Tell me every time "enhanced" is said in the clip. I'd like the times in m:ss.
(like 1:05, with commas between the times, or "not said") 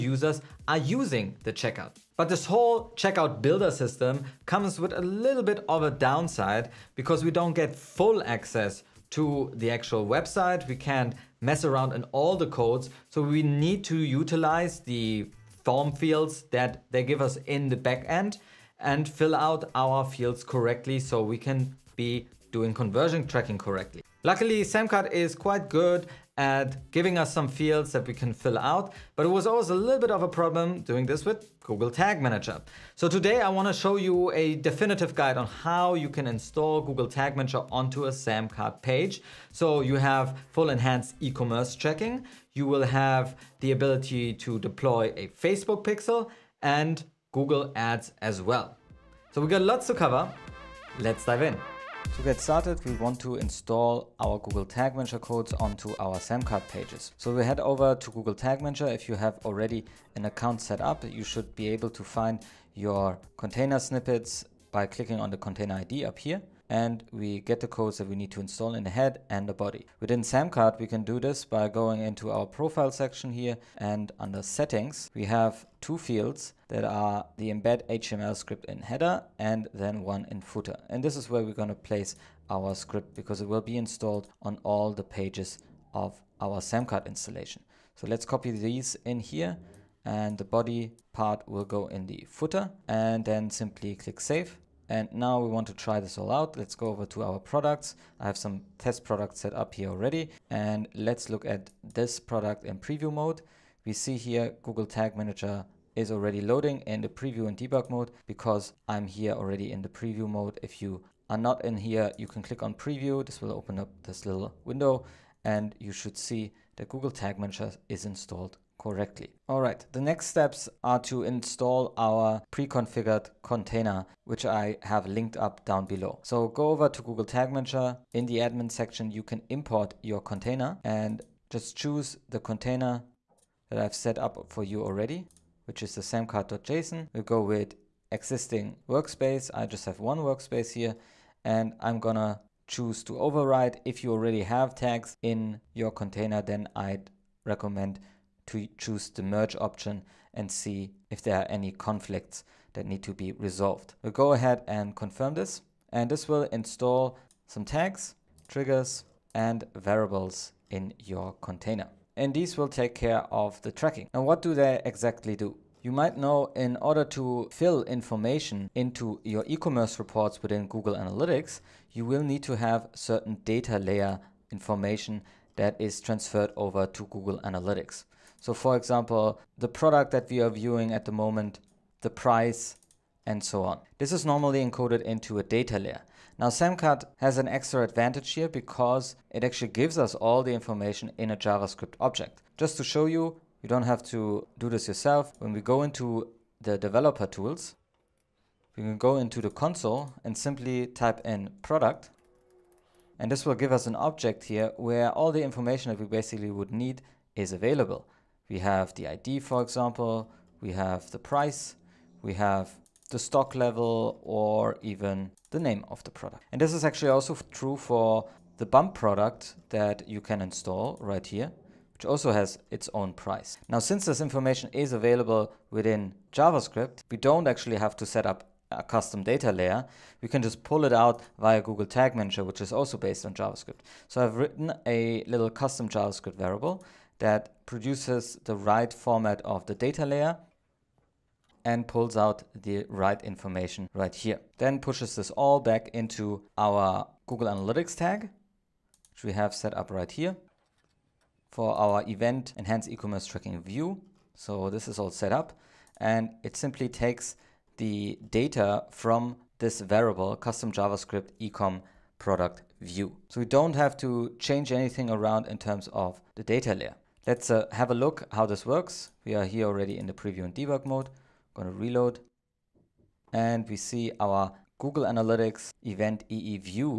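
0:40, 4:12.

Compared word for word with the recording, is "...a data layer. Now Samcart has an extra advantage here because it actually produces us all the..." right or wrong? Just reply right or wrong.
wrong.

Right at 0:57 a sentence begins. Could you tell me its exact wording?
So we head over to Google Tag Manager.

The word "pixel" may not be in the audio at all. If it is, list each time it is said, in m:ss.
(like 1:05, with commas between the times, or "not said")
0:45.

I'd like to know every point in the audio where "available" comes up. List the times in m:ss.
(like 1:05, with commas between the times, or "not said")
3:27, 3:44.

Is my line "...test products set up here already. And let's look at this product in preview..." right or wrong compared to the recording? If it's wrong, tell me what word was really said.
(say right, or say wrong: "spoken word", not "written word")
right.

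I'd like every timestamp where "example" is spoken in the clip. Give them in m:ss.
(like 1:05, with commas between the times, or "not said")
2:58, 3:29.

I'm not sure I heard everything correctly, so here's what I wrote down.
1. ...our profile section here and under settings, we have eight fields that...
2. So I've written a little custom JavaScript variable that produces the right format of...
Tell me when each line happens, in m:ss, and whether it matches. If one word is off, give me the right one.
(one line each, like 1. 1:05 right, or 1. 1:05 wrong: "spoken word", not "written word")
1. 1:12 wrong: "two", not "eight"
2. 3:54 right.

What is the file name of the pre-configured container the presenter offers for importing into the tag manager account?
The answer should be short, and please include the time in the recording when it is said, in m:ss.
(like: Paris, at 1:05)
samcart.json, at 2:16.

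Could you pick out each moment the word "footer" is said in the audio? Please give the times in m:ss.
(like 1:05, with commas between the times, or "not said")
1:20, 1:32.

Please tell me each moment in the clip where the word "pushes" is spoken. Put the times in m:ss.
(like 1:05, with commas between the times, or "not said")
4:04.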